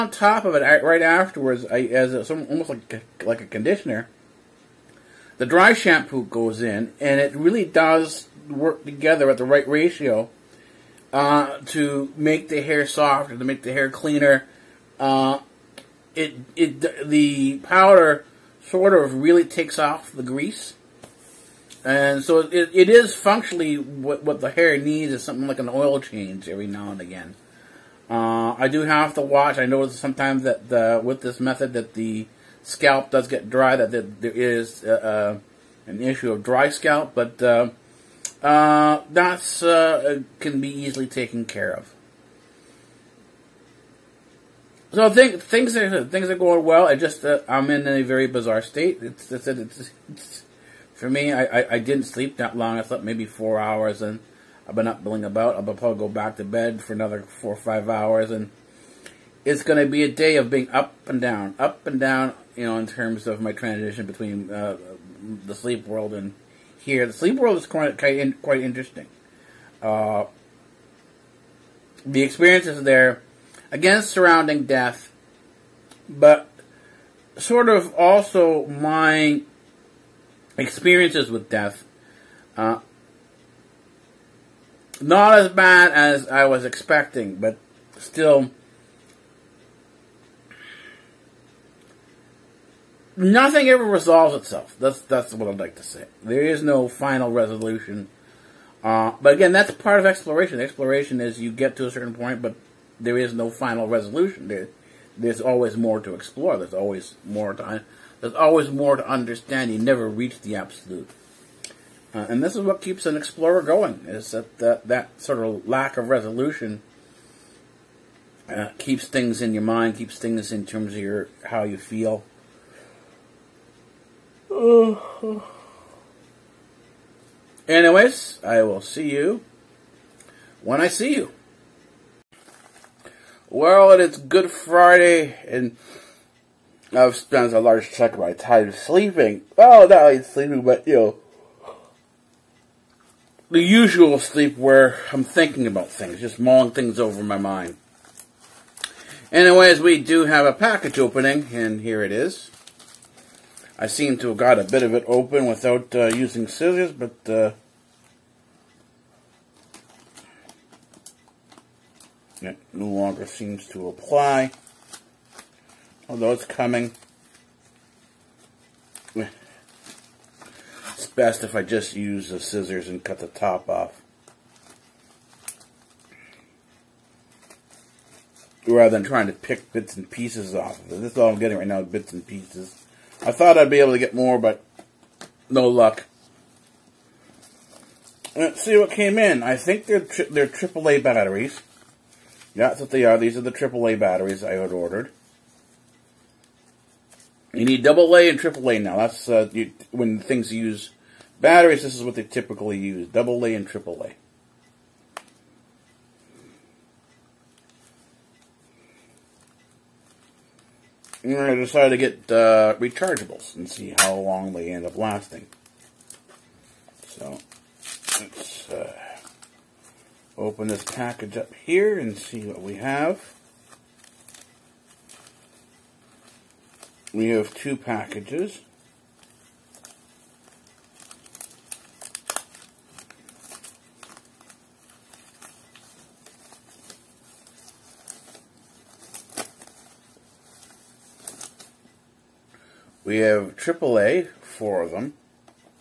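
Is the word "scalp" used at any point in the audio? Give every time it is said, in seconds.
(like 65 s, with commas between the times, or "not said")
32 s, 36 s.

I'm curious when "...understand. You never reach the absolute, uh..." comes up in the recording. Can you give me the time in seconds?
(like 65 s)
109 s.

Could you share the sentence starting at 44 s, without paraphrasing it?
So think, things are things are going well.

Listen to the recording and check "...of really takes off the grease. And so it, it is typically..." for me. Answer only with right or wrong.
wrong.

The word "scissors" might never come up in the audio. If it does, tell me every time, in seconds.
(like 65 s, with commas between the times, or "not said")
156 s, 172 s.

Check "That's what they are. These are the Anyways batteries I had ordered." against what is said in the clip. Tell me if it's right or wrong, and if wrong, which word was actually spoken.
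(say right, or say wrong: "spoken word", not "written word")
wrong: "AAA", not "Anyways".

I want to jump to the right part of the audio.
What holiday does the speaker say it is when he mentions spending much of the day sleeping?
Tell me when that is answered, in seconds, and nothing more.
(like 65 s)
134 s.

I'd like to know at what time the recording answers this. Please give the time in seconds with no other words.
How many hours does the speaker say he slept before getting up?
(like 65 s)
53 s.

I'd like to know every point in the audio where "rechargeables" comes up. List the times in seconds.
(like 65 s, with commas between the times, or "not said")
212 s.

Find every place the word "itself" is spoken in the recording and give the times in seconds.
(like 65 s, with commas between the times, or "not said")
94 s.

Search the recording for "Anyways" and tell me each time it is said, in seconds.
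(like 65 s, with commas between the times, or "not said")
127 s, 149 s.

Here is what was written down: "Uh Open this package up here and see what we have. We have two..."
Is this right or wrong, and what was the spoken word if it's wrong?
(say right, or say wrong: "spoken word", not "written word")
right.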